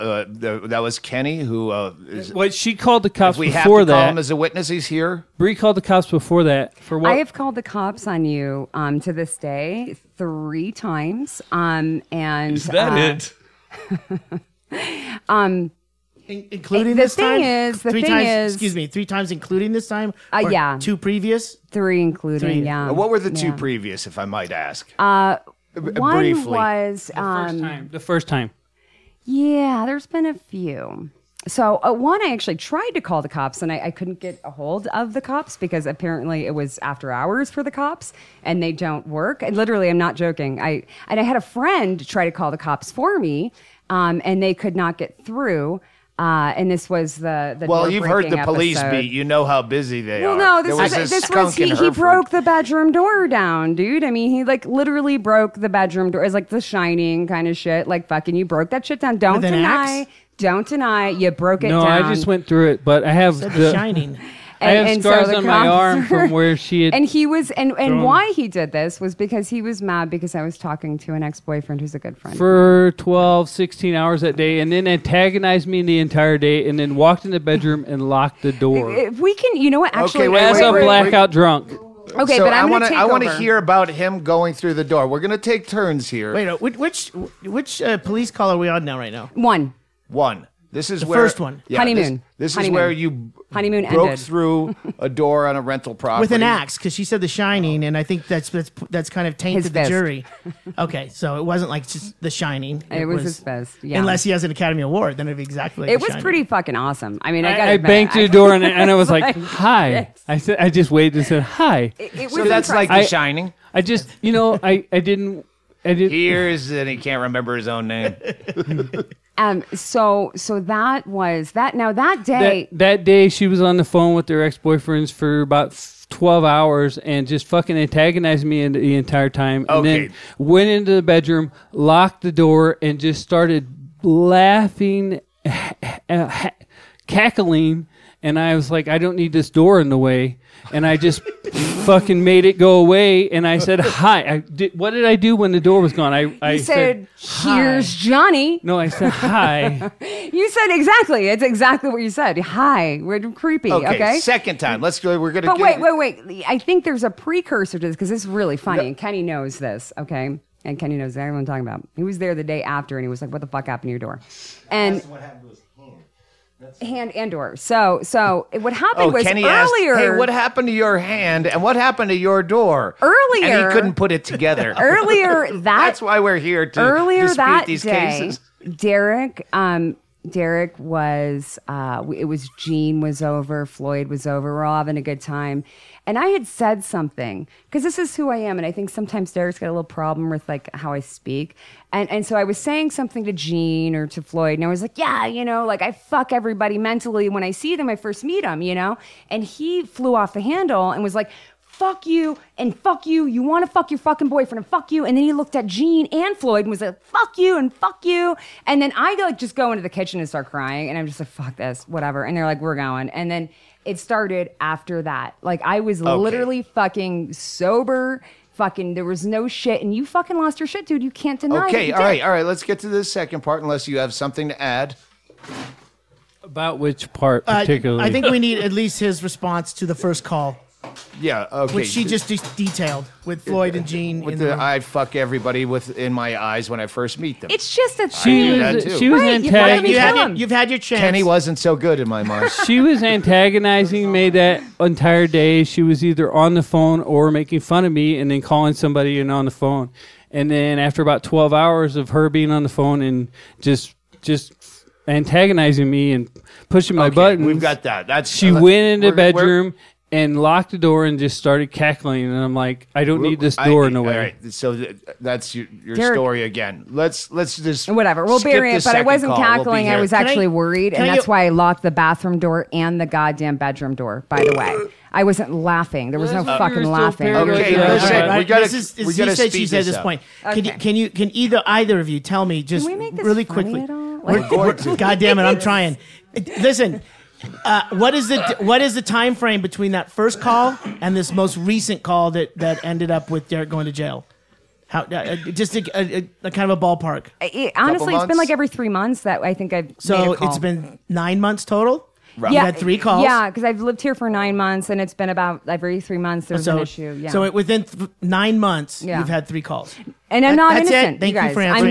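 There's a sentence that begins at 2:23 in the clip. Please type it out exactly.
And I said, "Hi." I did, what did I do when the door was gone?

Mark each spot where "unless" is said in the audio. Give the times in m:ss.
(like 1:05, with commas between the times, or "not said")
1:43, 3:43.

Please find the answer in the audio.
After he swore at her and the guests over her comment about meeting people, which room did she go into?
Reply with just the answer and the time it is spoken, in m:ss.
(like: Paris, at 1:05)
kitchen, at 3:29.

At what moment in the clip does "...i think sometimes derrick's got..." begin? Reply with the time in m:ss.
3:08.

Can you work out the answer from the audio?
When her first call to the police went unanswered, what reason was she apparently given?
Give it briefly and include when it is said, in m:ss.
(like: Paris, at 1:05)
after hours, at 0:36.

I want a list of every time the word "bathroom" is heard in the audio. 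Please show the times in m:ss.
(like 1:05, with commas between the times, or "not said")
4:31.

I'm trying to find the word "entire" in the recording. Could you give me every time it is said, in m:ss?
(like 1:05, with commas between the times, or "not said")
1:15, 2:08, 4:04.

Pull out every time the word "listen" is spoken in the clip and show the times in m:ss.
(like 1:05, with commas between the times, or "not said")
4:37, 4:46.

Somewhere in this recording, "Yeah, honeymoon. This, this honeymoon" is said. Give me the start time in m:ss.
1:31.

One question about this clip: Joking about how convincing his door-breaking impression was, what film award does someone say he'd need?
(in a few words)
Academy Award.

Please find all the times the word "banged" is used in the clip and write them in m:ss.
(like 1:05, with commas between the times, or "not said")
1:47.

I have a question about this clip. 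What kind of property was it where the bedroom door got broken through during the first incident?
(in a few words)
rental property.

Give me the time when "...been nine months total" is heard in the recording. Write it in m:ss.
5:00.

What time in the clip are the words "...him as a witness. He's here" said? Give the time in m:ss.
0:04.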